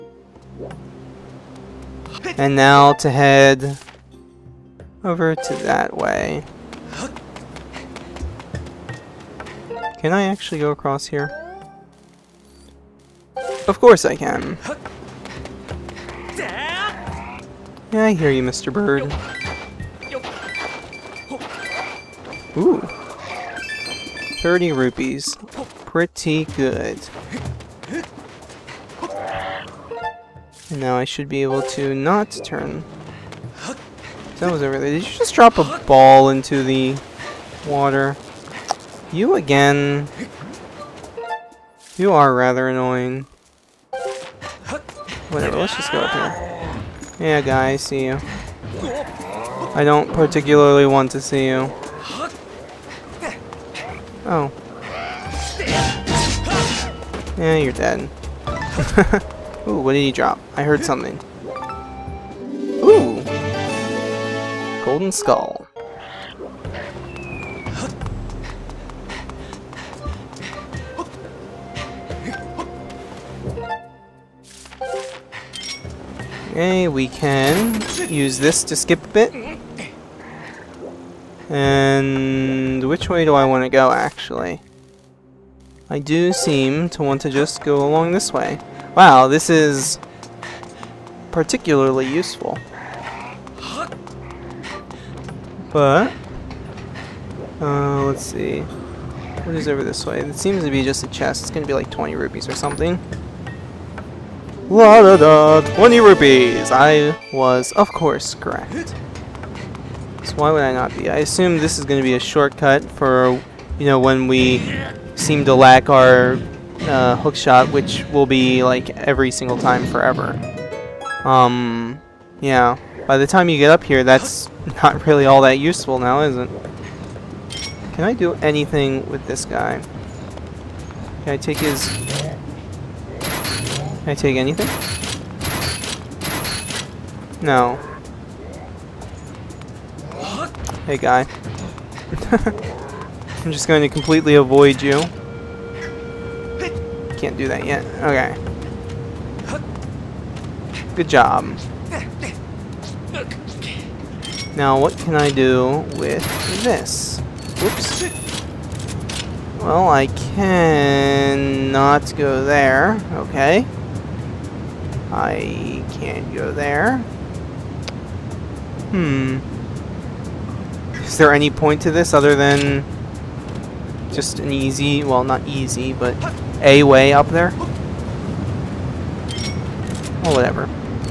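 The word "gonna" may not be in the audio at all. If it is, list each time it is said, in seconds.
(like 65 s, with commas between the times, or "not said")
101 s, 111 s.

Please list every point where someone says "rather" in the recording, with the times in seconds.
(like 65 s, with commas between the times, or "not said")
42 s.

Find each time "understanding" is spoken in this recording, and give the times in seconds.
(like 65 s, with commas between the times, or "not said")
not said.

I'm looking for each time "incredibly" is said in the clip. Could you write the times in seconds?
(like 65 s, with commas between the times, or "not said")
not said.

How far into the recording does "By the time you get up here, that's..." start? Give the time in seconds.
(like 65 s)
123 s.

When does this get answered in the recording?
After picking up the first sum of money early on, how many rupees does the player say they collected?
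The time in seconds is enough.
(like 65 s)
24 s.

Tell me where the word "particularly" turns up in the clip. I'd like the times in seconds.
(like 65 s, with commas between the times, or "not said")
50 s, 91 s.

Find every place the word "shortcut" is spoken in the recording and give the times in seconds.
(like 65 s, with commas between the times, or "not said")
112 s.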